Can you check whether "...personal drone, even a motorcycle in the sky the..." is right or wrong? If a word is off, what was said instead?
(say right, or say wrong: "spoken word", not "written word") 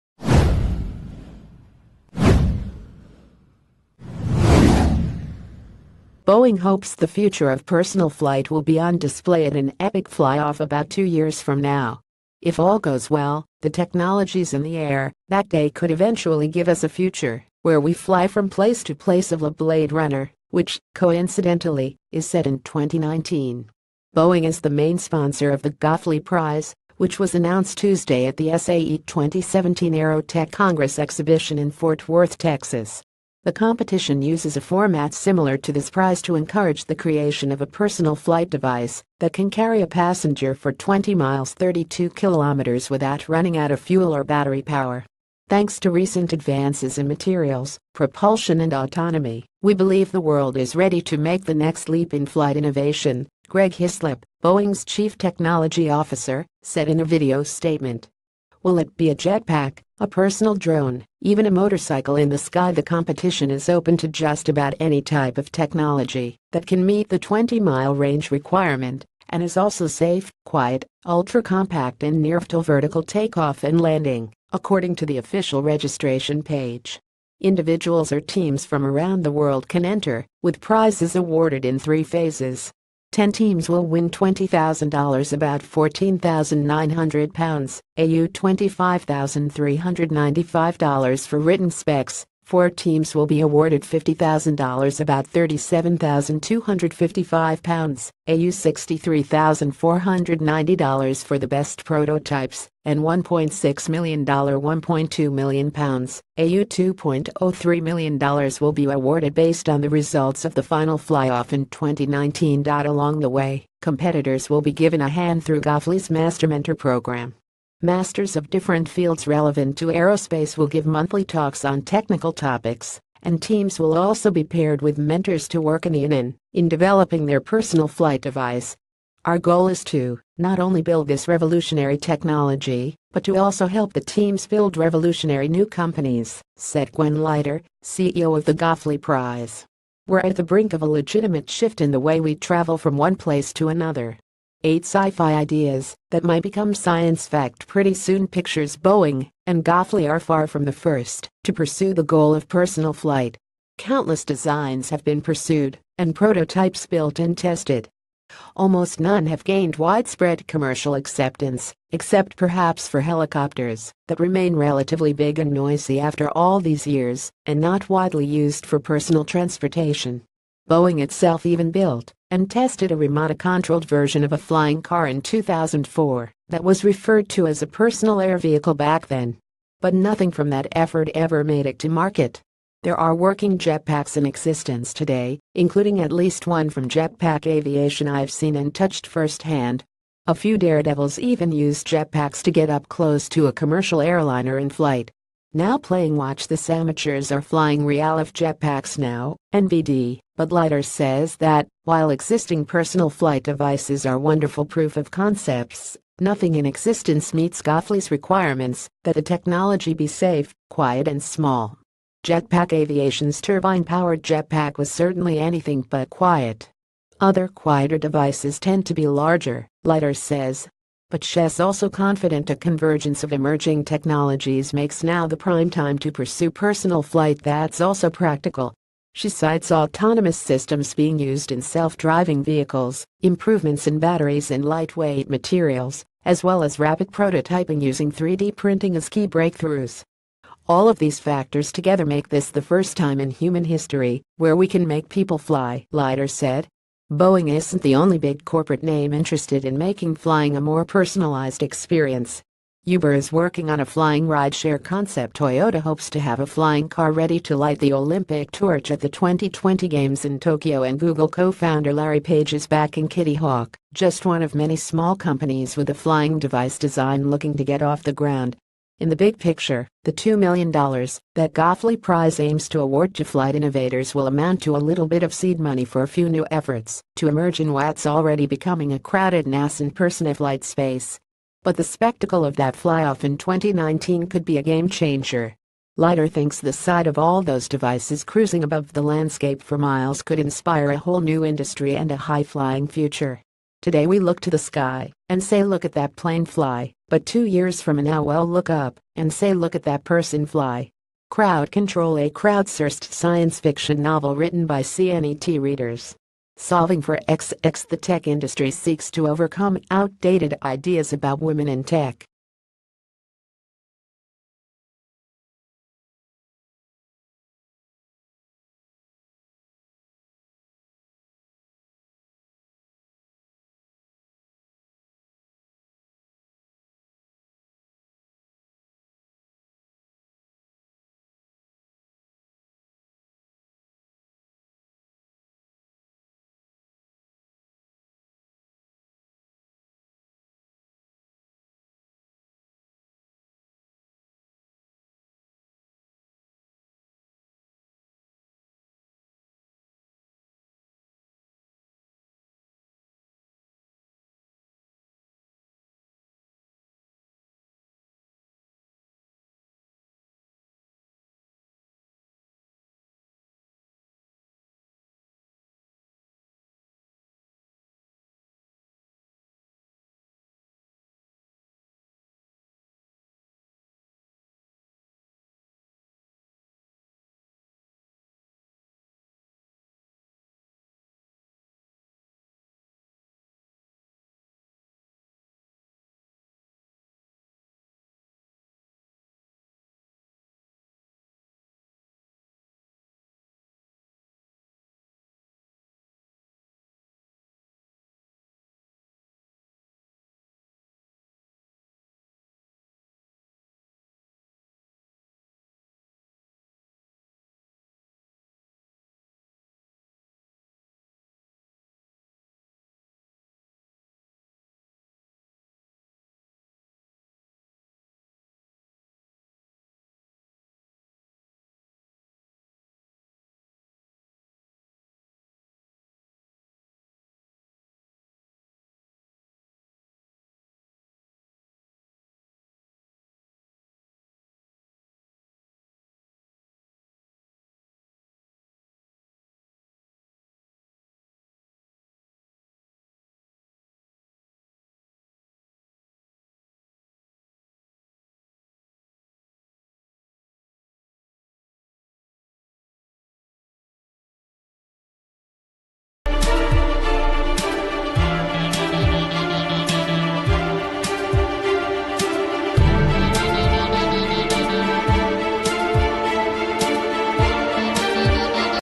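right.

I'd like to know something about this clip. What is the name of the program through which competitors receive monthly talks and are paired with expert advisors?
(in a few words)
Master Mentor.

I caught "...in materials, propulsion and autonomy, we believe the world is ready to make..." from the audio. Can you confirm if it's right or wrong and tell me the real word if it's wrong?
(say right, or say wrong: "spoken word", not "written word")
right.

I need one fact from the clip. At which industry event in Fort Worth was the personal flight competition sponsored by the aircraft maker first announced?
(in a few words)
SAE 2017 Aerotech Congress.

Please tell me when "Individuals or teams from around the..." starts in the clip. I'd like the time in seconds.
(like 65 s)
77 s.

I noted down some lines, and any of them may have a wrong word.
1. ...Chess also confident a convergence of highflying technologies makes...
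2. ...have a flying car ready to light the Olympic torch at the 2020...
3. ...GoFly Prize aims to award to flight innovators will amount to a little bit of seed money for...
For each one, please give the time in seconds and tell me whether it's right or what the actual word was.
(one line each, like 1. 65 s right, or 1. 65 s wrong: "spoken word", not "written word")
1. 221 s wrong: "emerging", not "highflying"
2. 256 s right
3. 271 s right.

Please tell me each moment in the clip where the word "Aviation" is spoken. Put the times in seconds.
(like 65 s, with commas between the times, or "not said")
187 s, 212 s.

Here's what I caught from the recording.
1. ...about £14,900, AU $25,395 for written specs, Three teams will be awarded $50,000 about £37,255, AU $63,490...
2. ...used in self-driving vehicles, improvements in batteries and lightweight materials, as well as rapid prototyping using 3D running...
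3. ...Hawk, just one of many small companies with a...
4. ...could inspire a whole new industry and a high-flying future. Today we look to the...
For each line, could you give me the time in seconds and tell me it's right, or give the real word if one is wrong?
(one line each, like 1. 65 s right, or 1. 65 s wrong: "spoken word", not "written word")
1. 85 s wrong: "Four", not "Three"
2. 231 s wrong: "printing", not "running"
3. 263 s right
4. 290 s right.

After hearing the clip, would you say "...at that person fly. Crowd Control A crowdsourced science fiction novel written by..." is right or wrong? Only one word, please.
right.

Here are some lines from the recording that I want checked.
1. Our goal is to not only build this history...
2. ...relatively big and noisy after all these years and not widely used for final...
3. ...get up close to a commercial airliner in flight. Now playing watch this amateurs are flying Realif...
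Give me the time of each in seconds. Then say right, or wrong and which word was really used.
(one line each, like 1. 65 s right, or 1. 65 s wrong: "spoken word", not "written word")
1. 129 s wrong: "revolutionary", not "history"
2. 164 s wrong: "personal", not "final"
3. 192 s right.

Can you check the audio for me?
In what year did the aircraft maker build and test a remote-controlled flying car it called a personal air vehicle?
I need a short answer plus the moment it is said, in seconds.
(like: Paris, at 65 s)
2004, at 175 s.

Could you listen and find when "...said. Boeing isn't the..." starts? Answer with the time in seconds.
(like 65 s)
246 s.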